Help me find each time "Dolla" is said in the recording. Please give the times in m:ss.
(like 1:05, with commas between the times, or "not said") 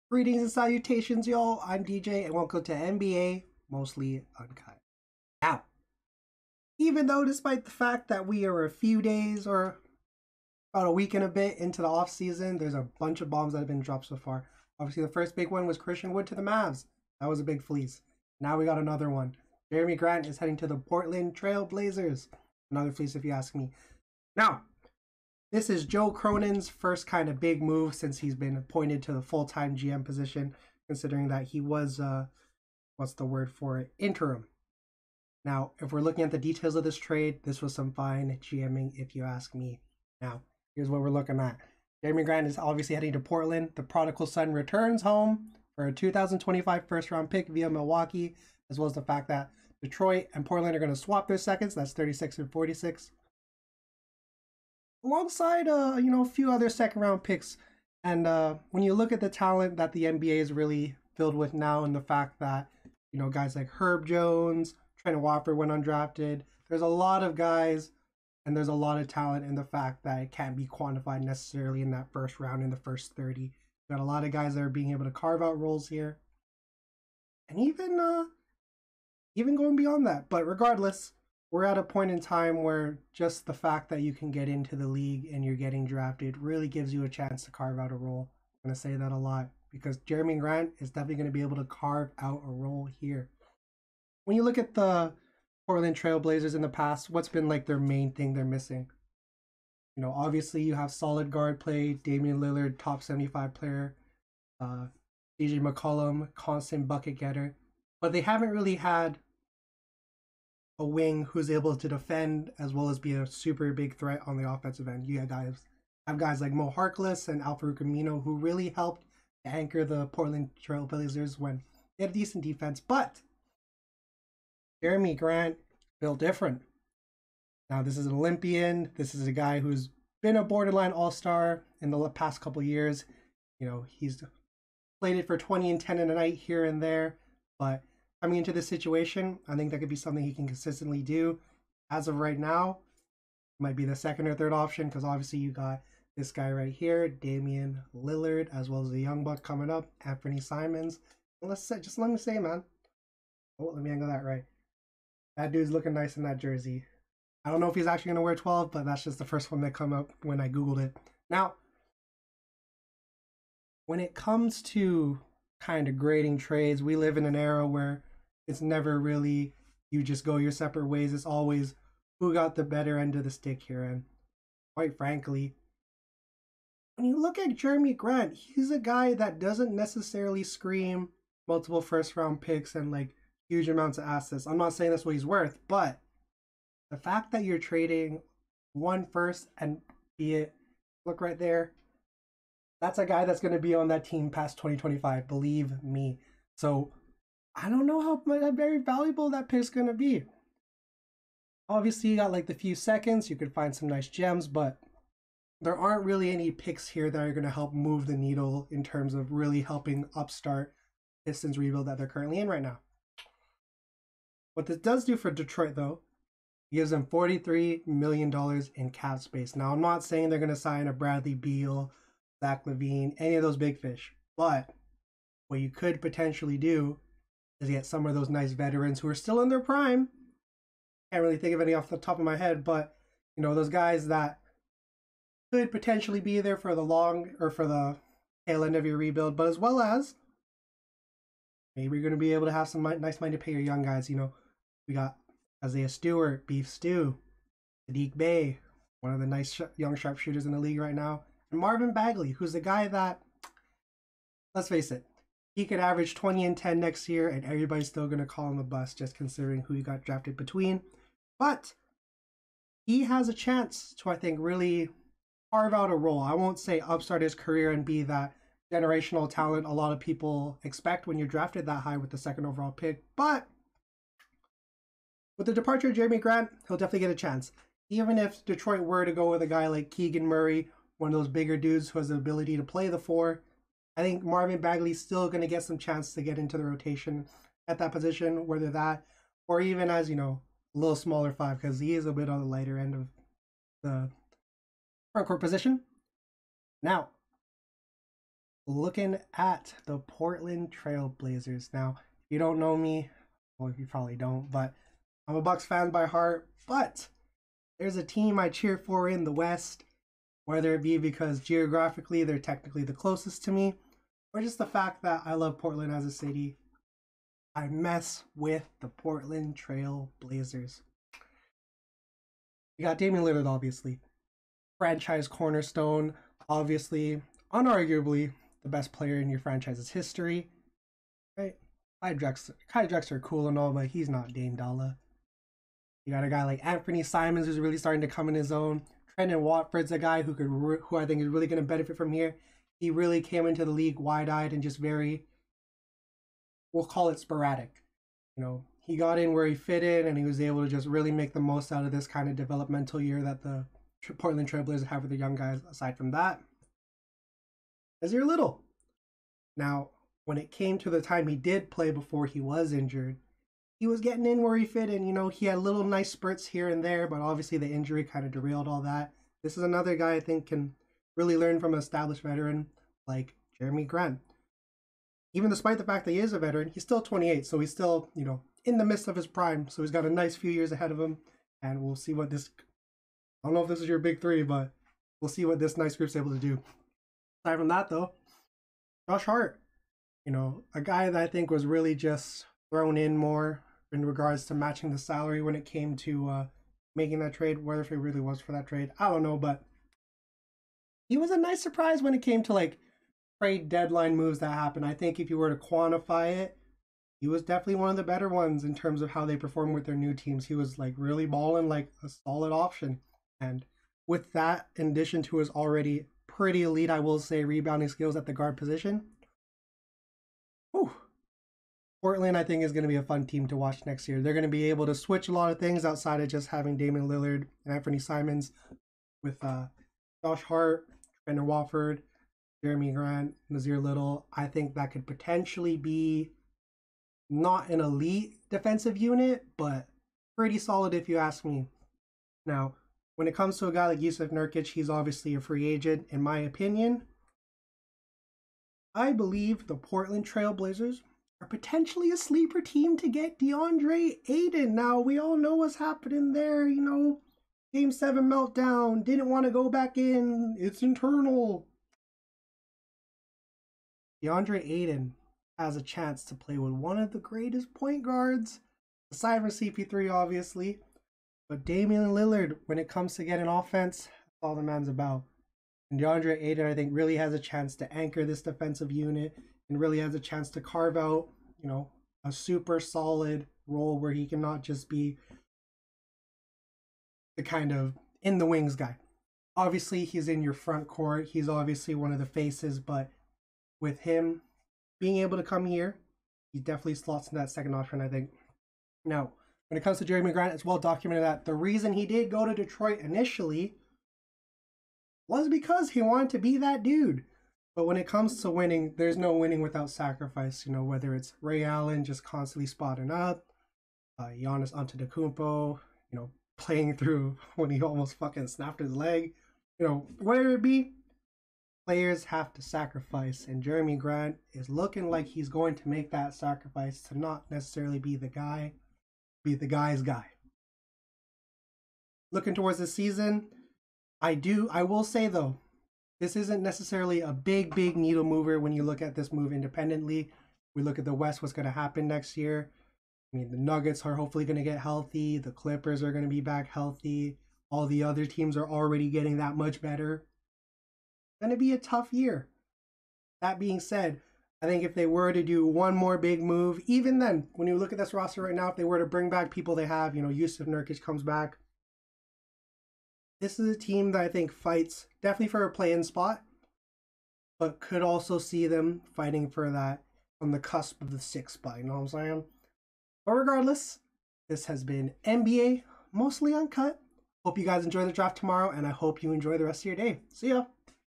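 5:34.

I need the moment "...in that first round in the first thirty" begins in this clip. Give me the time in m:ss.
1:11.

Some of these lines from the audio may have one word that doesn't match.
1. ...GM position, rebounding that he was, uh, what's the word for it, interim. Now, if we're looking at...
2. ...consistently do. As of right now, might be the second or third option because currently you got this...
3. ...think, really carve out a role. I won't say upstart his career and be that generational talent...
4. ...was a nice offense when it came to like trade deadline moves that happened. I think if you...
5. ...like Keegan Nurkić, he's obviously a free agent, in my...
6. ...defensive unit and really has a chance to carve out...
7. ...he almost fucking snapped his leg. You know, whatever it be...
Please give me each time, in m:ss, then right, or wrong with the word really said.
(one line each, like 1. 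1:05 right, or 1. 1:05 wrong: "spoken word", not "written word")
1. 0:29 wrong: "considering", not "rebounding"
2. 2:20 wrong: "obviously", not "currently"
3. 4:24 right
4. 6:41 wrong: "surprise", not "offense"
5. 7:23 wrong: "Jusuf", not "Keegan"
6. 7:58 right
7. 8:37 right.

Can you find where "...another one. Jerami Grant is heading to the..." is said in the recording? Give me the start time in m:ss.
0:18.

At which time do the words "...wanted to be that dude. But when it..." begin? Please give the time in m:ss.
8:26.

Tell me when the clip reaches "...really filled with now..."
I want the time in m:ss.
1:00.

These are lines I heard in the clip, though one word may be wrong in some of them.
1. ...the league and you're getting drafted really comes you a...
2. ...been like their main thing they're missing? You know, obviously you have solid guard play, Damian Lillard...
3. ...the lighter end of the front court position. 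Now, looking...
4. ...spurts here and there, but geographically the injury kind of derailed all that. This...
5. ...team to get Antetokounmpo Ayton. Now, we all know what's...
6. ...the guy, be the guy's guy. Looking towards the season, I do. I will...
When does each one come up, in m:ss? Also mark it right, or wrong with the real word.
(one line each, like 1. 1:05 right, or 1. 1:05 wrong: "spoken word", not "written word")
1. 1:24 wrong: "gives", not "comes"
2. 1:37 right
3. 4:52 right
4. 6:06 wrong: "obviously", not "geographically"
5. 7:32 wrong: "Deandre", not "Antetokounmpo"
6. 8:48 right.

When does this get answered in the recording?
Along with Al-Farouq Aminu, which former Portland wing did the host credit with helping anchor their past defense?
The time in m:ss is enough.
1:56.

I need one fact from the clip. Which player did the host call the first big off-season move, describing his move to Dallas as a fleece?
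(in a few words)
Christian Wood.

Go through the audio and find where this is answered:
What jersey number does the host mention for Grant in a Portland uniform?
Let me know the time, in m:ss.
2:38.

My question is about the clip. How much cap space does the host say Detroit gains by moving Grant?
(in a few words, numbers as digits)
$43 million.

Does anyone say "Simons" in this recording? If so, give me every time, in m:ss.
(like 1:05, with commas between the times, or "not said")
2:30, 5:37, 7:07.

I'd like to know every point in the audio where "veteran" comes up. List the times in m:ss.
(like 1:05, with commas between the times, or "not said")
3:48, 6:12, 6:16.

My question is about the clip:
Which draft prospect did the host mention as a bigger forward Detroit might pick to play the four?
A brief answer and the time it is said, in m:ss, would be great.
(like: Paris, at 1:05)
Keegan Murray, at 4:39.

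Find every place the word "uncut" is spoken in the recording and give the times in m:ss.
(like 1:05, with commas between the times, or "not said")
0:04, 9:36.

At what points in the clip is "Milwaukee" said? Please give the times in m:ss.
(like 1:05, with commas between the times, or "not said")
0:47.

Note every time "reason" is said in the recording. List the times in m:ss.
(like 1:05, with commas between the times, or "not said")
8:21.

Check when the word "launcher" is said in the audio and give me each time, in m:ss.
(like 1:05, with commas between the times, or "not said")
not said.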